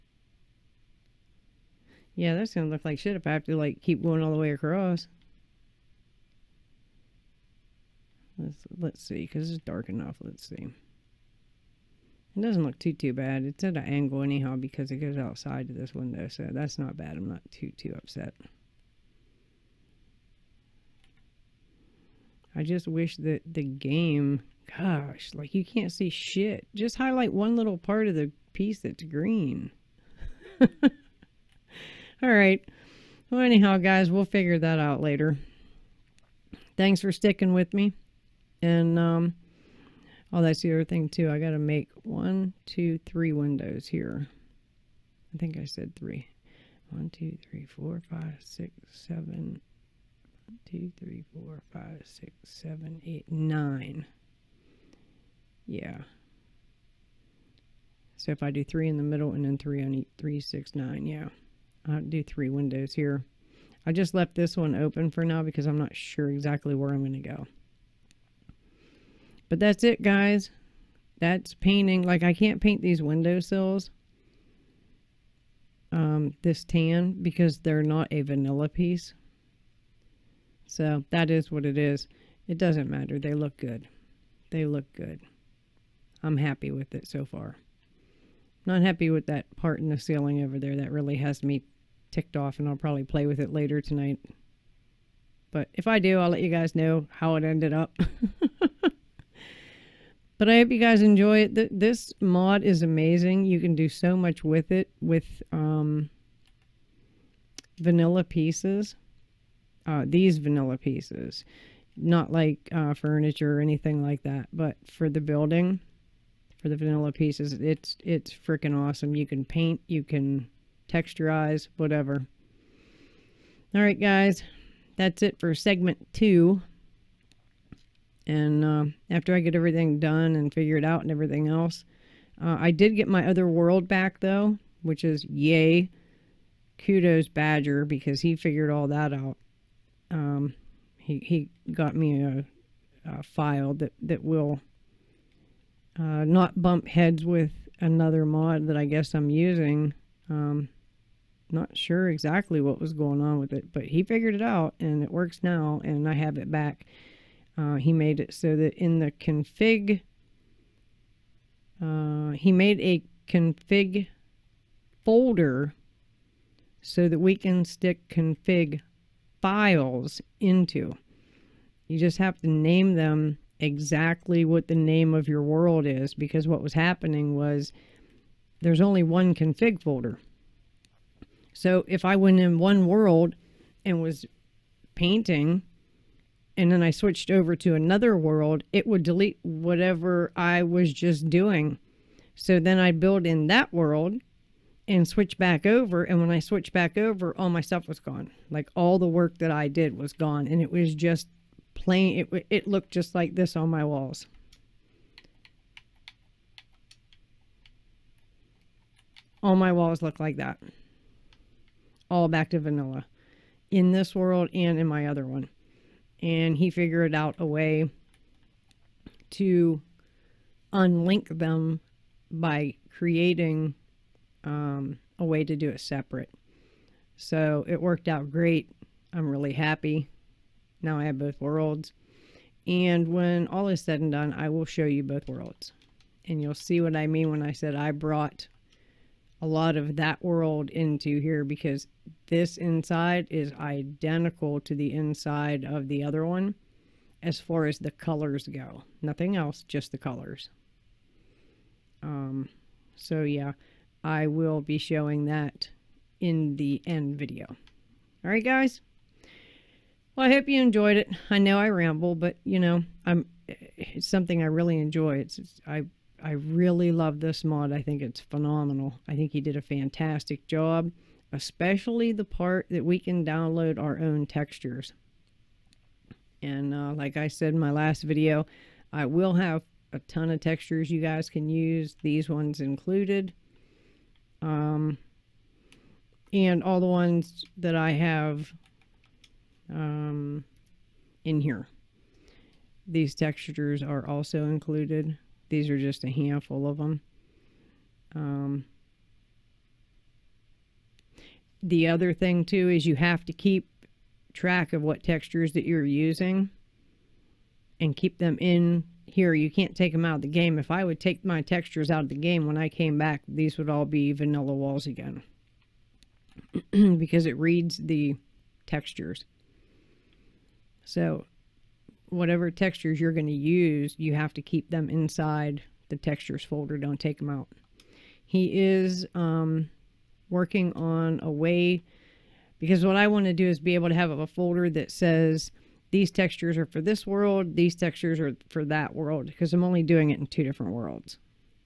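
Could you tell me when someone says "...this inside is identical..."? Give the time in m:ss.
4:02.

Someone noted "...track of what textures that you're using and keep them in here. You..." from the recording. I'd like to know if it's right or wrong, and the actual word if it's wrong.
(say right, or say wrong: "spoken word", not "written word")
right.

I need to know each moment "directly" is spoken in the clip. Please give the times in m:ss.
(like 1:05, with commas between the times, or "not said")
not said.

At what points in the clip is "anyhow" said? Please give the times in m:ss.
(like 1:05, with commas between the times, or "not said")
0:14, 0:33.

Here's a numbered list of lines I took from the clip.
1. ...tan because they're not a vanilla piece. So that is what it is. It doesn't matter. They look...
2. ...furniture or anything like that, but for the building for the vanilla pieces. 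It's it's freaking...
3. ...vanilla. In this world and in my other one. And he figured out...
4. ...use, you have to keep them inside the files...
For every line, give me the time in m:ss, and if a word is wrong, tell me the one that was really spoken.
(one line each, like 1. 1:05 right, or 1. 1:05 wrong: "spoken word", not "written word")
1. 1:16 right
2. 1:52 right
3. 3:32 right
4. 5:23 wrong: "textures", not "files".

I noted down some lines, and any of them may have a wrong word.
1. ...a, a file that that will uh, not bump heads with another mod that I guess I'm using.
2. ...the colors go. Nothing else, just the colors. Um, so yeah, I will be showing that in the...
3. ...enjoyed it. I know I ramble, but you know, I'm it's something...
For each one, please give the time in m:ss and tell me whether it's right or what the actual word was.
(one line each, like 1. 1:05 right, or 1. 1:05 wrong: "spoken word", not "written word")
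1. 2:22 right
2. 4:07 right
3. 4:20 right.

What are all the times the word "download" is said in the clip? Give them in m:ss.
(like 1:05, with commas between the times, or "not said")
4:33.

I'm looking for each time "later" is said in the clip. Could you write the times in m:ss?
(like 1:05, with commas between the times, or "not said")
0:35, 1:33.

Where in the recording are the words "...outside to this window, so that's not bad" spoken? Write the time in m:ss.
0:15.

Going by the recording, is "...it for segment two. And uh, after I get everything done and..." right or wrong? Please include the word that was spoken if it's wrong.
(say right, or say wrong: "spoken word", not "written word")
right.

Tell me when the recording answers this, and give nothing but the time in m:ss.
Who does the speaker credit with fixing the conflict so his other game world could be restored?
2:17.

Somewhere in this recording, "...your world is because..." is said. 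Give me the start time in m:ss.
2:55.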